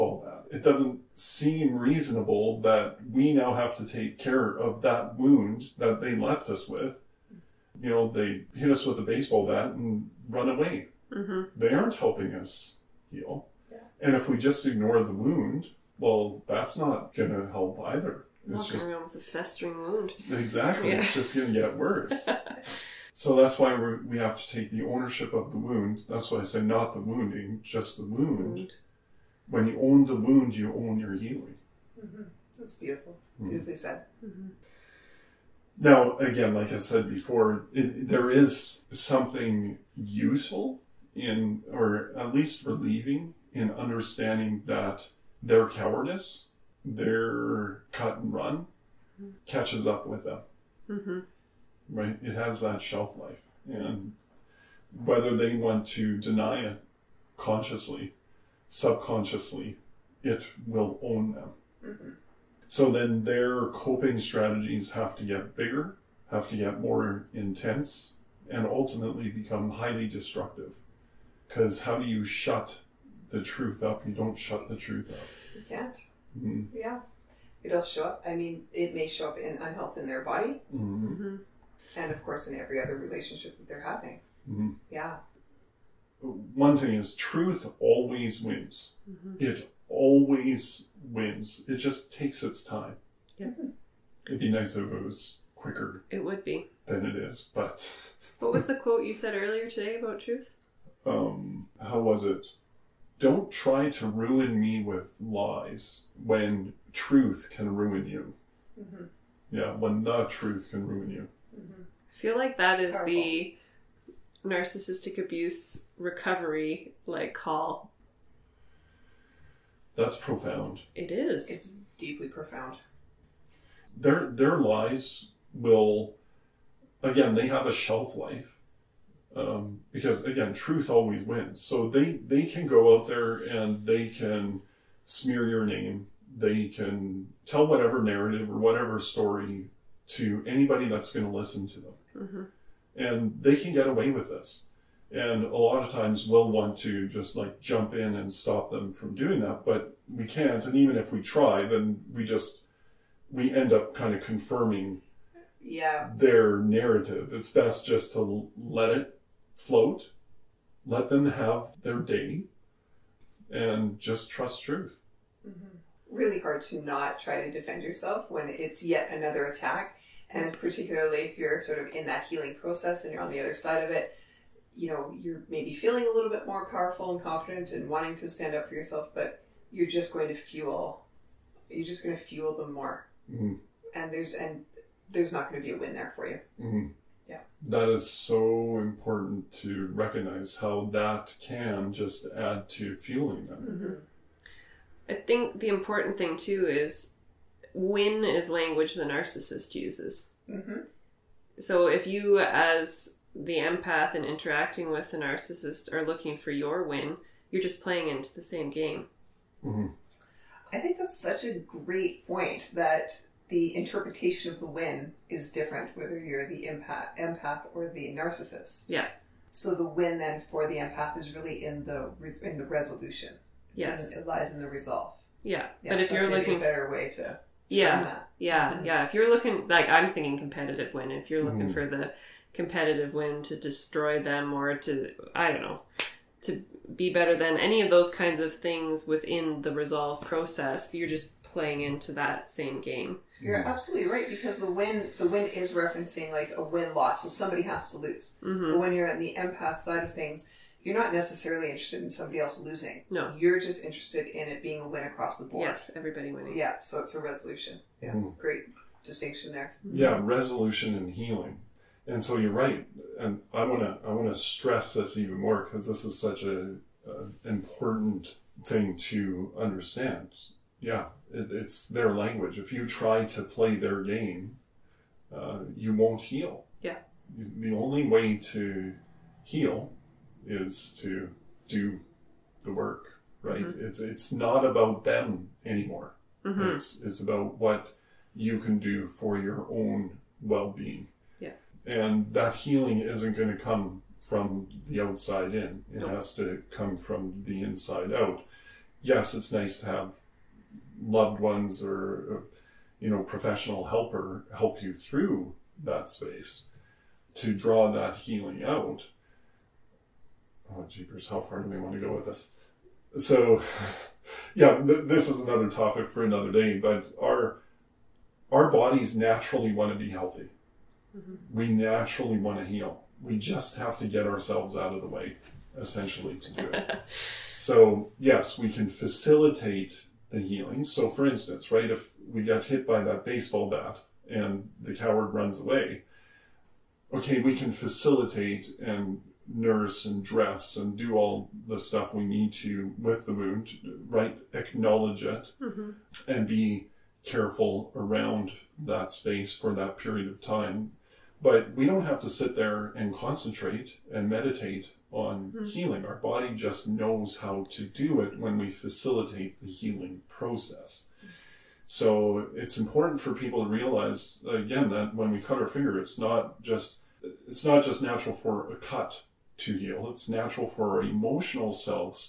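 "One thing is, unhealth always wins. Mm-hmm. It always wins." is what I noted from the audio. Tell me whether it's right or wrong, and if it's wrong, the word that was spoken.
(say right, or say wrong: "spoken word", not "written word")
wrong: "truth", not "unhealth".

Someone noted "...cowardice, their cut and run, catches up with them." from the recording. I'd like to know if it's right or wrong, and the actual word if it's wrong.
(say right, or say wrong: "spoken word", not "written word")
right.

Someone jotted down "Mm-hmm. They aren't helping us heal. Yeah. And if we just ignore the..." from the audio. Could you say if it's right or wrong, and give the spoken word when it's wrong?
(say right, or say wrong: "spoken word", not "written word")
right.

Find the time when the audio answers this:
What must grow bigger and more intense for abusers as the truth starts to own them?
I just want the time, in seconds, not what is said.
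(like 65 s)
63 s.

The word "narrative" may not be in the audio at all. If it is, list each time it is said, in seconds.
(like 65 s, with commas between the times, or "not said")
138 s, 156 s.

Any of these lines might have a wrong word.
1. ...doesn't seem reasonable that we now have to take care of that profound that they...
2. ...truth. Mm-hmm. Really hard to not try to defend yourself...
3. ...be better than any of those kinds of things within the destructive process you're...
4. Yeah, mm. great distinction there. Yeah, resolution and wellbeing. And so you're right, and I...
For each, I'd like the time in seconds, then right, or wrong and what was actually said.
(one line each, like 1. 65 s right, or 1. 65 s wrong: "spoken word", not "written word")
1. 0 s wrong: "wound", not "profound"
2. 164 s right
3. 236 s wrong: "resolve", not "destructive"
4. 257 s wrong: "healing", not "wellbeing".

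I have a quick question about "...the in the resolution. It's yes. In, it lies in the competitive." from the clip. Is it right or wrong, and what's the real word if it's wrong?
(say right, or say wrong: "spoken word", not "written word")
wrong: "resolve", not "competitive".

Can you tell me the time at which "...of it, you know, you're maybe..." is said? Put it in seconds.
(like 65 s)
173 s.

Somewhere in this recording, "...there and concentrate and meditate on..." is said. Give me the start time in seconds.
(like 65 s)
352 s.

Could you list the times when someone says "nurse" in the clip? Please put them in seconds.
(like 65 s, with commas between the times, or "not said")
339 s.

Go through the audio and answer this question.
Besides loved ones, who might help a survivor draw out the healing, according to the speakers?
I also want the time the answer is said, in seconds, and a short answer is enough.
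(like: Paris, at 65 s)
professional helper, at 303 s.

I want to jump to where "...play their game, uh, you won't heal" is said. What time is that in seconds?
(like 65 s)
273 s.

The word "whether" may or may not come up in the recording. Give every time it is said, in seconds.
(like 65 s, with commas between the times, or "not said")
55 s, 215 s.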